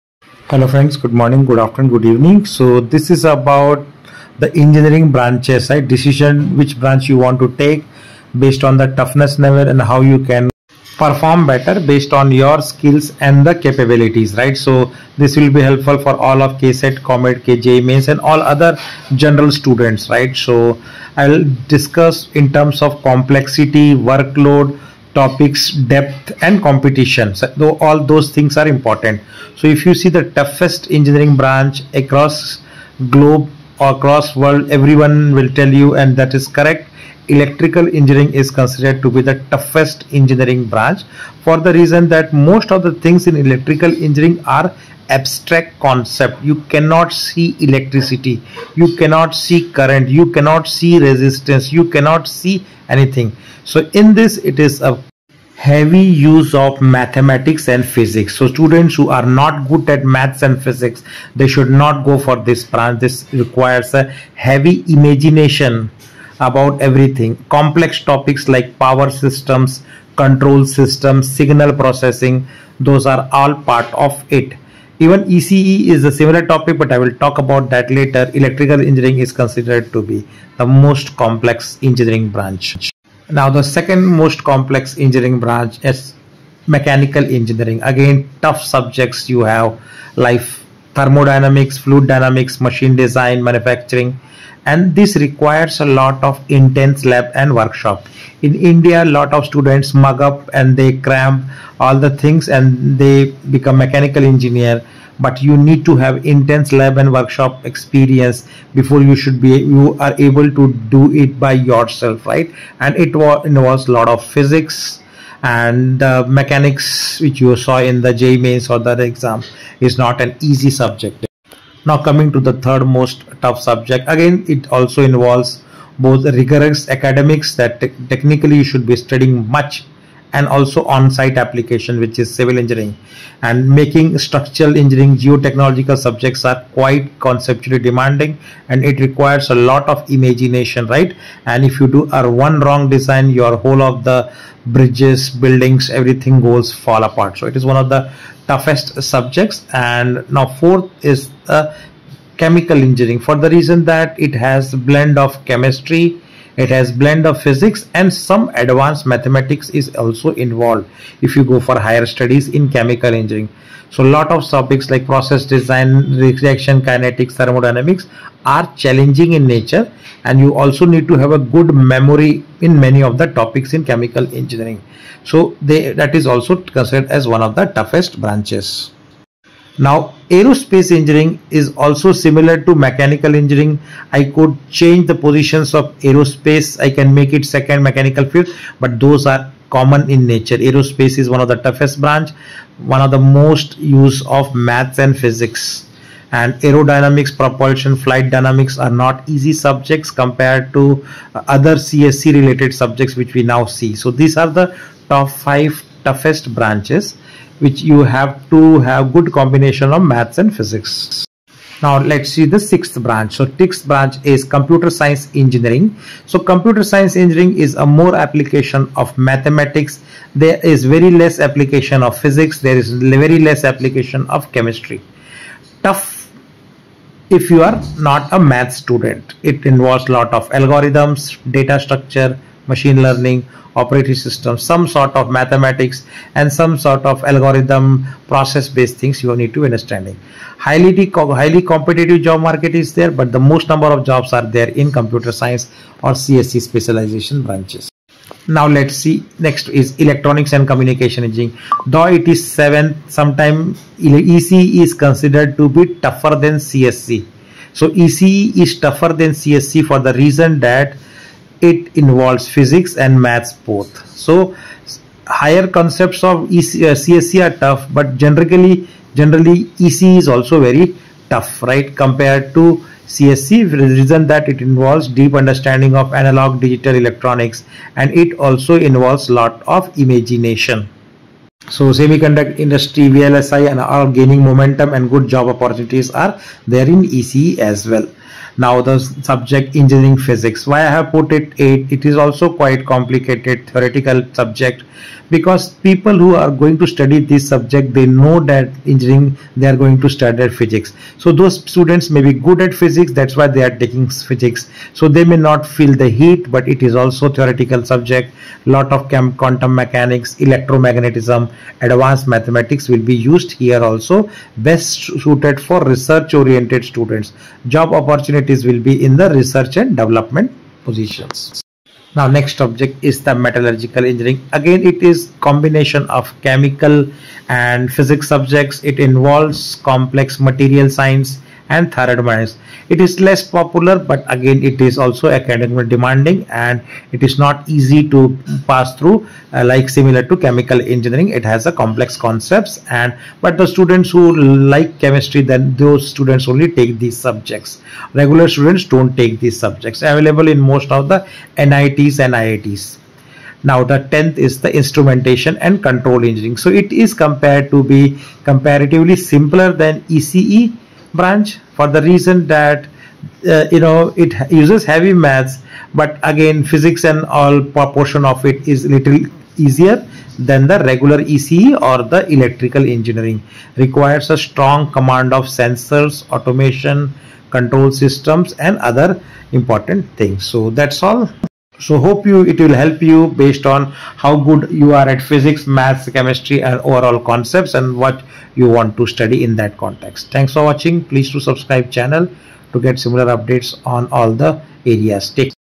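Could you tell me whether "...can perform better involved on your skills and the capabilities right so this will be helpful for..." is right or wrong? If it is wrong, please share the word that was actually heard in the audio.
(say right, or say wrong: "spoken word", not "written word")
wrong: "based", not "involved".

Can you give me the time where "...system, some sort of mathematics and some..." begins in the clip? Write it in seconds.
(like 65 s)
234 s.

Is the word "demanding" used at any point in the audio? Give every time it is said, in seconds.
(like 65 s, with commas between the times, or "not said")
137 s, 335 s.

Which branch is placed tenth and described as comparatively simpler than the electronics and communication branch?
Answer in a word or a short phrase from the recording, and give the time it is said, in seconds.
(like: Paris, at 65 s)
Instrumentation and control engineering, at 354 s.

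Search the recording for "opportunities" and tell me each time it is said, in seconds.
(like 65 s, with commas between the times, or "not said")
285 s, 317 s.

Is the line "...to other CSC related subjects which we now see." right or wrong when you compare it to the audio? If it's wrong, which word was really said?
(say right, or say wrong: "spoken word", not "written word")
right.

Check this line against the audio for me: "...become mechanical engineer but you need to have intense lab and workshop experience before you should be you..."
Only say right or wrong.
right.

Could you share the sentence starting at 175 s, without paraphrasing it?
So they, that is also considered as one of the toughest branches.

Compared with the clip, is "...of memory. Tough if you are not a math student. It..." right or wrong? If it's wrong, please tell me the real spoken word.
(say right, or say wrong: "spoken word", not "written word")
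wrong: "chemistry", not "memory".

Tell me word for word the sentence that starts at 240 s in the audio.
Highly, highly competitive job market is there but the most number of jobs are there in computer science or CSC specialization branches.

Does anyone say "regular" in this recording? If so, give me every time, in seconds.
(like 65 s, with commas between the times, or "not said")
348 s, 370 s.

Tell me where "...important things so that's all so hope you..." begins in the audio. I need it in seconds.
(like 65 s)
379 s.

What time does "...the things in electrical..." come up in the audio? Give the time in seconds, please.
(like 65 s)
42 s.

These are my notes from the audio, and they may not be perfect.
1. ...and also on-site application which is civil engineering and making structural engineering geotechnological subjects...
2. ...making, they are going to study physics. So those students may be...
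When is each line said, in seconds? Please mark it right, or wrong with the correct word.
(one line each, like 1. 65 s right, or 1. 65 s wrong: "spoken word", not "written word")
1. 130 s right
2. 298 s wrong: "engineering", not "making".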